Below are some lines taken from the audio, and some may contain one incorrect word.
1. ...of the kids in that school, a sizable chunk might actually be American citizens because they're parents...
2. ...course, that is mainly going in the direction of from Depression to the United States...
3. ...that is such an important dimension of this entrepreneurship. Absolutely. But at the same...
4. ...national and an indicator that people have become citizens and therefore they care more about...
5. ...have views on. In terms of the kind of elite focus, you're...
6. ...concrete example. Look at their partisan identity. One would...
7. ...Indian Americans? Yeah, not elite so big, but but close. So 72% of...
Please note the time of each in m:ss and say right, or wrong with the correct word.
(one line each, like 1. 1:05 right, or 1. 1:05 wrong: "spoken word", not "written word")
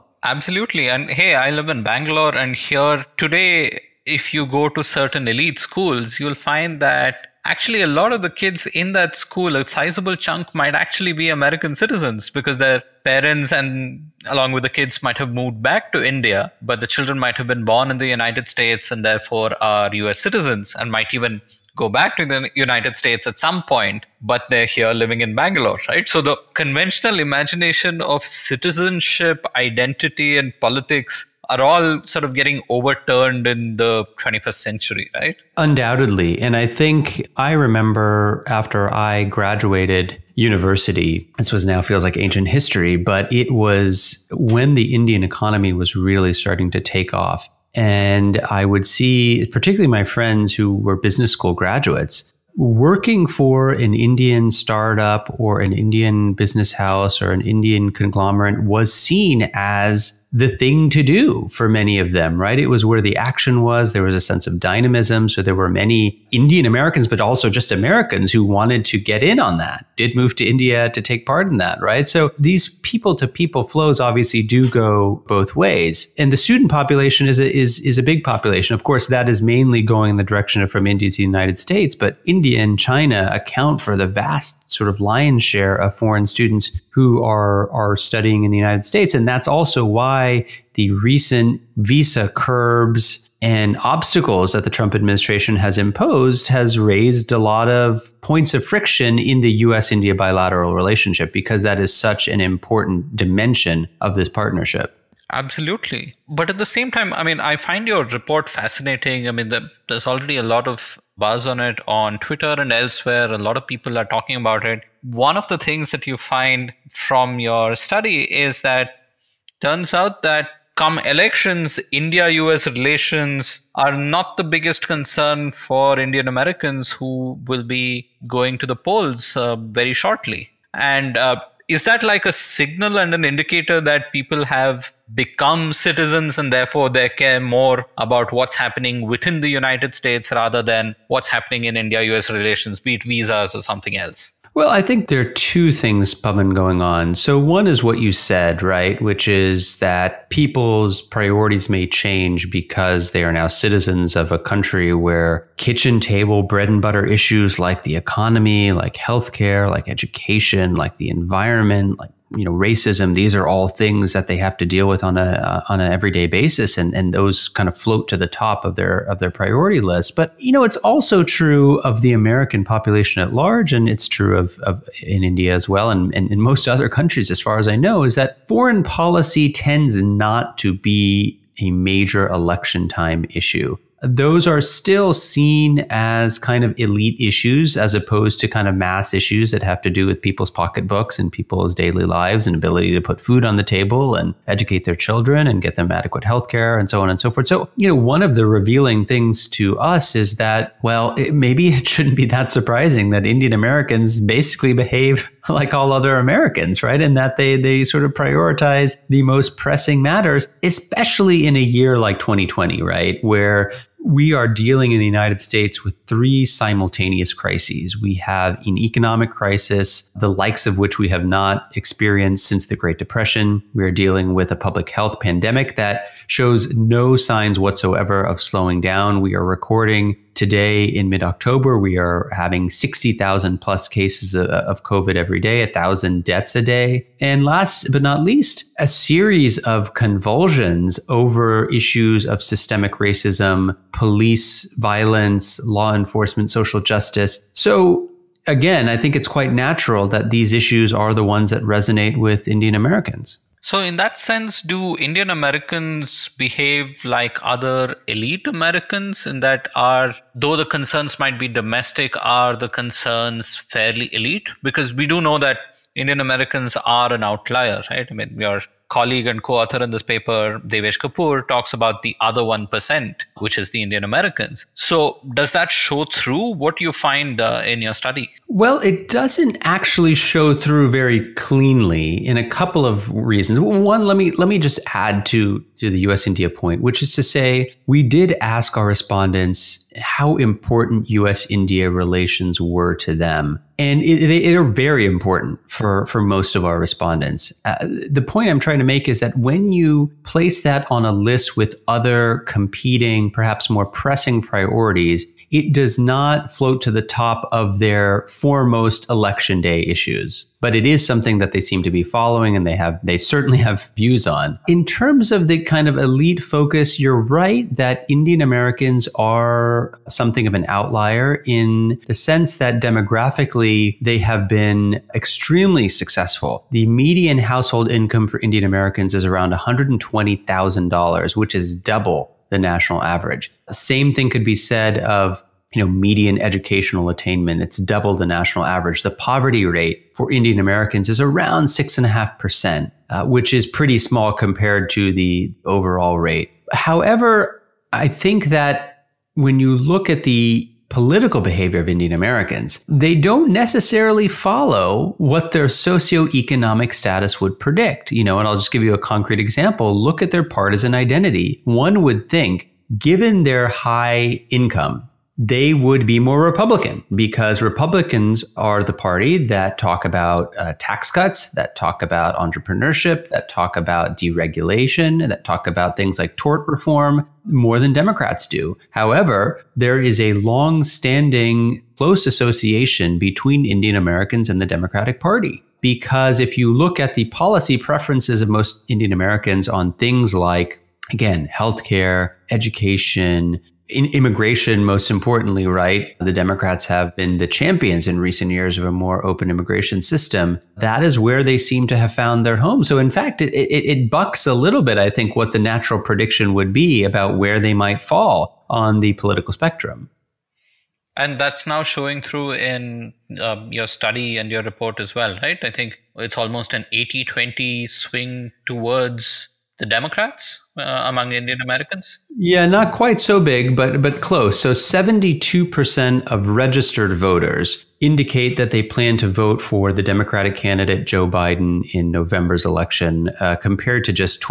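1. 0:08 right
2. 1:18 wrong: "India", not "Depression"
3. 1:41 wrong: "partnership", not "entrepreneurship"
4. 2:12 wrong: "signal", not "national"
5. 5:13 right
6. 5:58 right
7. 7:01 wrong: "quite", not "elite".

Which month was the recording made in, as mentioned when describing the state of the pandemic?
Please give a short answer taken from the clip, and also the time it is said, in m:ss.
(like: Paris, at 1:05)
October, at 3:51.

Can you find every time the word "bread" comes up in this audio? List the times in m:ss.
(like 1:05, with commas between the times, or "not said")
2:36.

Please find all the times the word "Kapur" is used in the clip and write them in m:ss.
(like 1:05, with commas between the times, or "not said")
4:30.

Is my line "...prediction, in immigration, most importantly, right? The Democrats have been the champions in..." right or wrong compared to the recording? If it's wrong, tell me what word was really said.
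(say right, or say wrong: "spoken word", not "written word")
wrong: "education", not "prediction".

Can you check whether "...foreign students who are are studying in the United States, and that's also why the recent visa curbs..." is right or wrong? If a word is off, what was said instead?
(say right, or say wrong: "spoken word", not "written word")
right.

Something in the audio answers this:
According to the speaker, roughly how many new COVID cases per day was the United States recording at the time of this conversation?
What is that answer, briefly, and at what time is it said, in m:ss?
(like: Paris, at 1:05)
60,000, at 3:52.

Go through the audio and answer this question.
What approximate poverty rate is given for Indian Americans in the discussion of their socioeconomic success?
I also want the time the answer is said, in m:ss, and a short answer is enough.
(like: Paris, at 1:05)
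6.5%, at 5:41.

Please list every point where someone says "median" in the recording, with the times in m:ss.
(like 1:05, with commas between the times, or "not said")
5:26, 5:35.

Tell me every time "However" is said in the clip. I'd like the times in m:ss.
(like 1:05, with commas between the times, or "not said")
5:46, 6:18.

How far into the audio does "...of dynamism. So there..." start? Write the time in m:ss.
1:04.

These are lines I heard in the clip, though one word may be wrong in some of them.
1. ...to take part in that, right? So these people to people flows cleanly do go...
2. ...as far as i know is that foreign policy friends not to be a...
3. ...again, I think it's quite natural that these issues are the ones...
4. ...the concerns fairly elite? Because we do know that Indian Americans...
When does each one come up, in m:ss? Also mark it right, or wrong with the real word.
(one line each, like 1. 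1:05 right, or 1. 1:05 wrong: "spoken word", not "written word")
1. 1:10 wrong: "obviously", not "cleanly"
2. 2:57 wrong: "tends", not "friends"
3. 4:08 right
4. 4:22 right.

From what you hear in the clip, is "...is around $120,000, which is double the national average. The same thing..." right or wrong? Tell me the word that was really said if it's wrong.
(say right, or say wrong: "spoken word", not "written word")
right.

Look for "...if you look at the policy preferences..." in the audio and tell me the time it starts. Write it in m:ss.
6:26.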